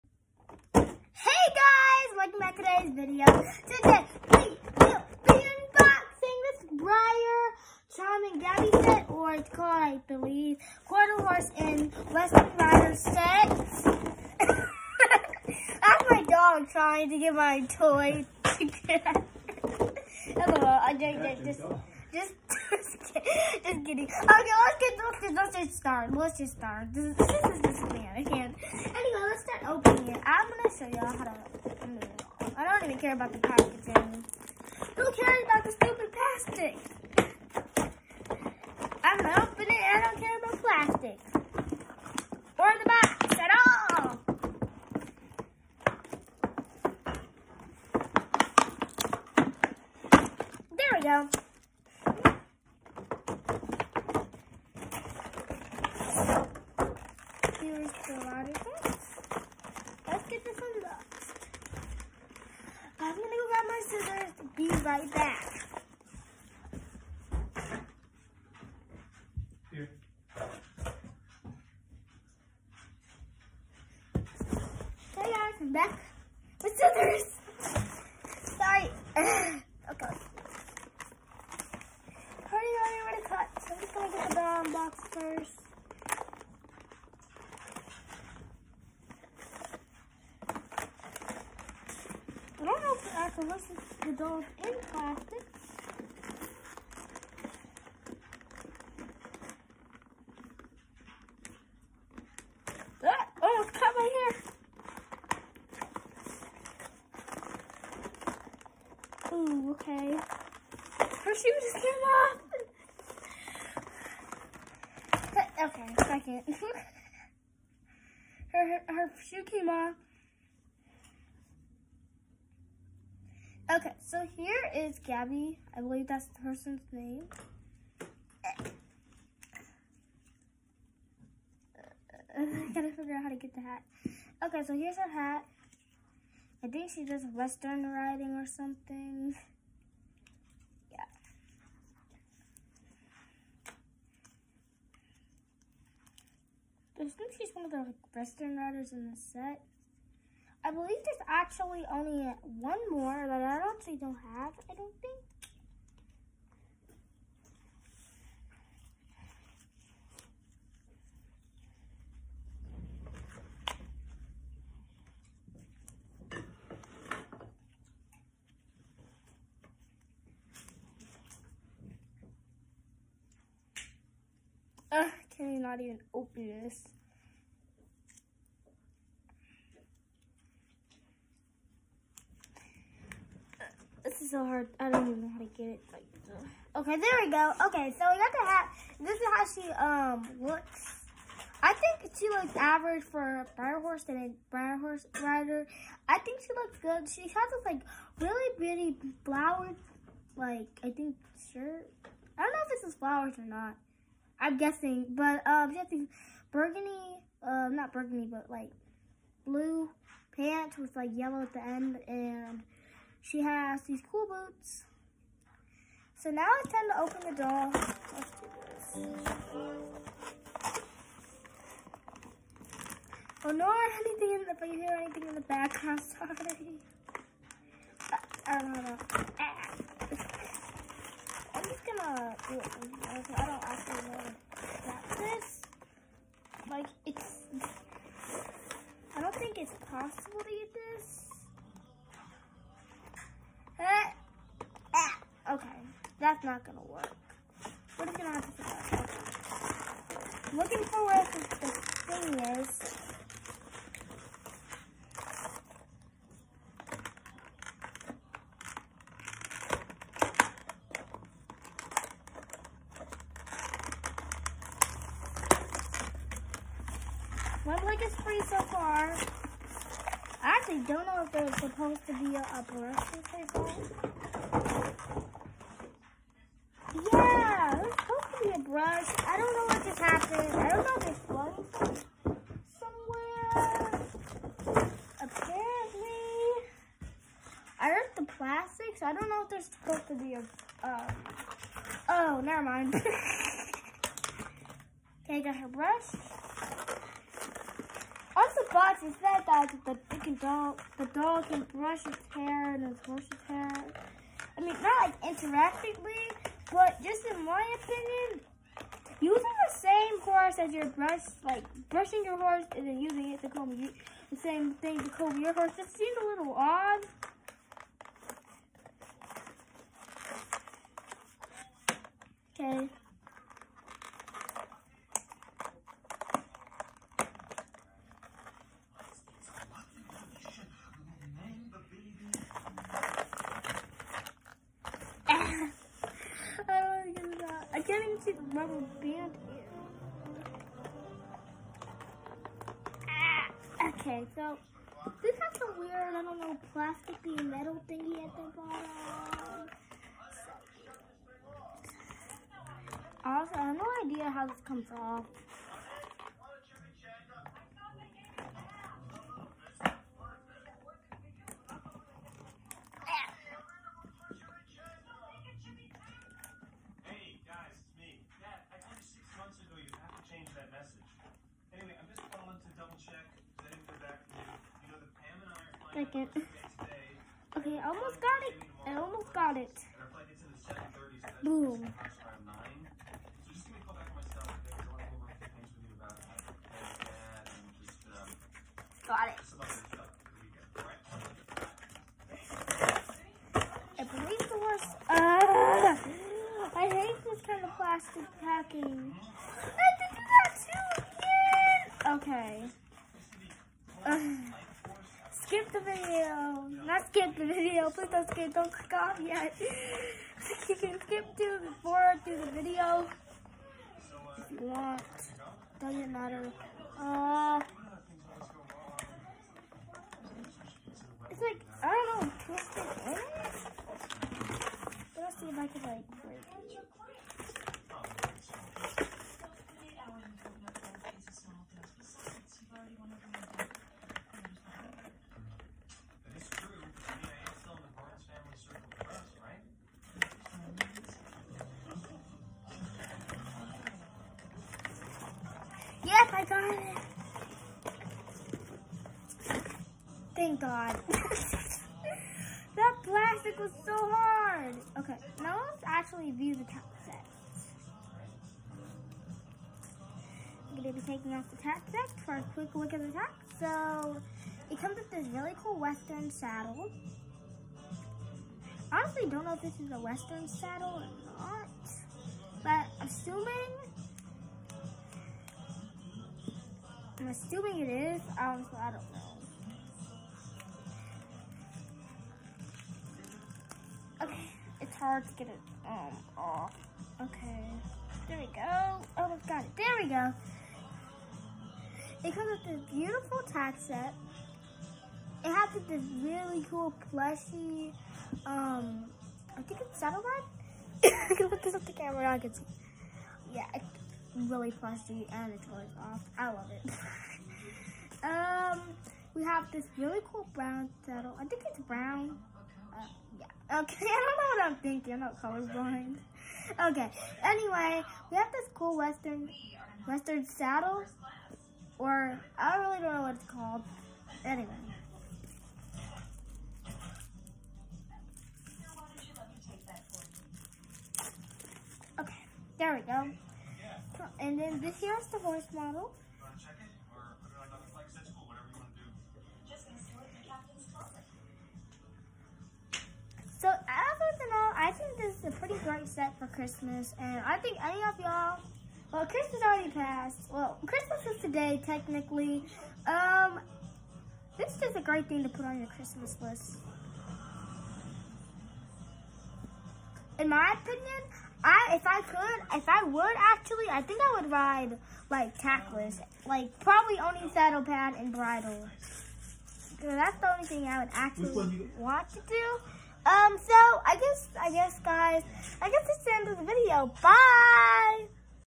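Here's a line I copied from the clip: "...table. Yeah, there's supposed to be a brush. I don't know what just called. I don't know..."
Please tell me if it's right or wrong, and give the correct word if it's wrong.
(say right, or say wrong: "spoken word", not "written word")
wrong: "happened", not "called".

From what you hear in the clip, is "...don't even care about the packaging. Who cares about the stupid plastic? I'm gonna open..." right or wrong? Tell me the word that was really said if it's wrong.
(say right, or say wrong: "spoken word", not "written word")
right.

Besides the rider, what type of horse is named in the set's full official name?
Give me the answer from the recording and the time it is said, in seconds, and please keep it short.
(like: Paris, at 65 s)
Quarter Horse, at 10 s.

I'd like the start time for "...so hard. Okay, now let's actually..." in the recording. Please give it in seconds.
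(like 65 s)
453 s.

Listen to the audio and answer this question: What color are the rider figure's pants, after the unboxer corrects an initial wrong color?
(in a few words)
blue.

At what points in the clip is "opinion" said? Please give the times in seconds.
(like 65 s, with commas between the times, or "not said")
307 s, 560 s.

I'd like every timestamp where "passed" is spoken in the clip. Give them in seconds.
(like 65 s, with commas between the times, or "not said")
549 s.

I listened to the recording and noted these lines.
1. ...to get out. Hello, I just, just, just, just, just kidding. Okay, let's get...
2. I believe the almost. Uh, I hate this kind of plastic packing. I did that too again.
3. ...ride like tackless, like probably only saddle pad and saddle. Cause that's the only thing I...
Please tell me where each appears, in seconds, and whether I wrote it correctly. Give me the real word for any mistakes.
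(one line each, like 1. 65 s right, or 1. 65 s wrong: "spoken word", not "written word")
1. 18 s right
2. 393 s wrong: "worst", not "almost"
3. 564 s wrong: "bridle", not "saddle".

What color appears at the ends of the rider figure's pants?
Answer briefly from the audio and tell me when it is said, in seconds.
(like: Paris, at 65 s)
yellow, at 211 s.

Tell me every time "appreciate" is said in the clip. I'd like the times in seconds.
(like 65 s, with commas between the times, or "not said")
not said.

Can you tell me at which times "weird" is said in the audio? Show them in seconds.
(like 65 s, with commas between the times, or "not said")
345 s.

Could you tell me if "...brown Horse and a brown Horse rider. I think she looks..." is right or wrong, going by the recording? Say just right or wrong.
right.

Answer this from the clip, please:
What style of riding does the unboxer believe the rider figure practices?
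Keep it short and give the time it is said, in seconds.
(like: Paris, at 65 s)
western riding, at 137 s.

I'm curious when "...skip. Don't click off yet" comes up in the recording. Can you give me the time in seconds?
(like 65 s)
408 s.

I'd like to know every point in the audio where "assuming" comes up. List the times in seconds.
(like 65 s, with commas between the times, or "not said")
473 s, 477 s.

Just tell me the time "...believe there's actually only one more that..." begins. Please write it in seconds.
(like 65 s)
150 s.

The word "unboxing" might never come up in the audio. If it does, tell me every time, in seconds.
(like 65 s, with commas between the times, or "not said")
5 s.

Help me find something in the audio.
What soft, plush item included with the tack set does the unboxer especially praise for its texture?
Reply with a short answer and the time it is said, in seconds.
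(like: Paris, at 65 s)
saddlebag, at 499 s.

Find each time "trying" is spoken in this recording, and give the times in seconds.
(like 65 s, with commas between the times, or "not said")
16 s.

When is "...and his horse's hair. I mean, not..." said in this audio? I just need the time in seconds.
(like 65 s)
302 s.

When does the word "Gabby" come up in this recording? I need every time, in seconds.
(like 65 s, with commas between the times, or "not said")
8 s, 124 s.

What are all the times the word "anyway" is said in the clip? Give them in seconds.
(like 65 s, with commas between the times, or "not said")
28 s, 517 s, 524 s.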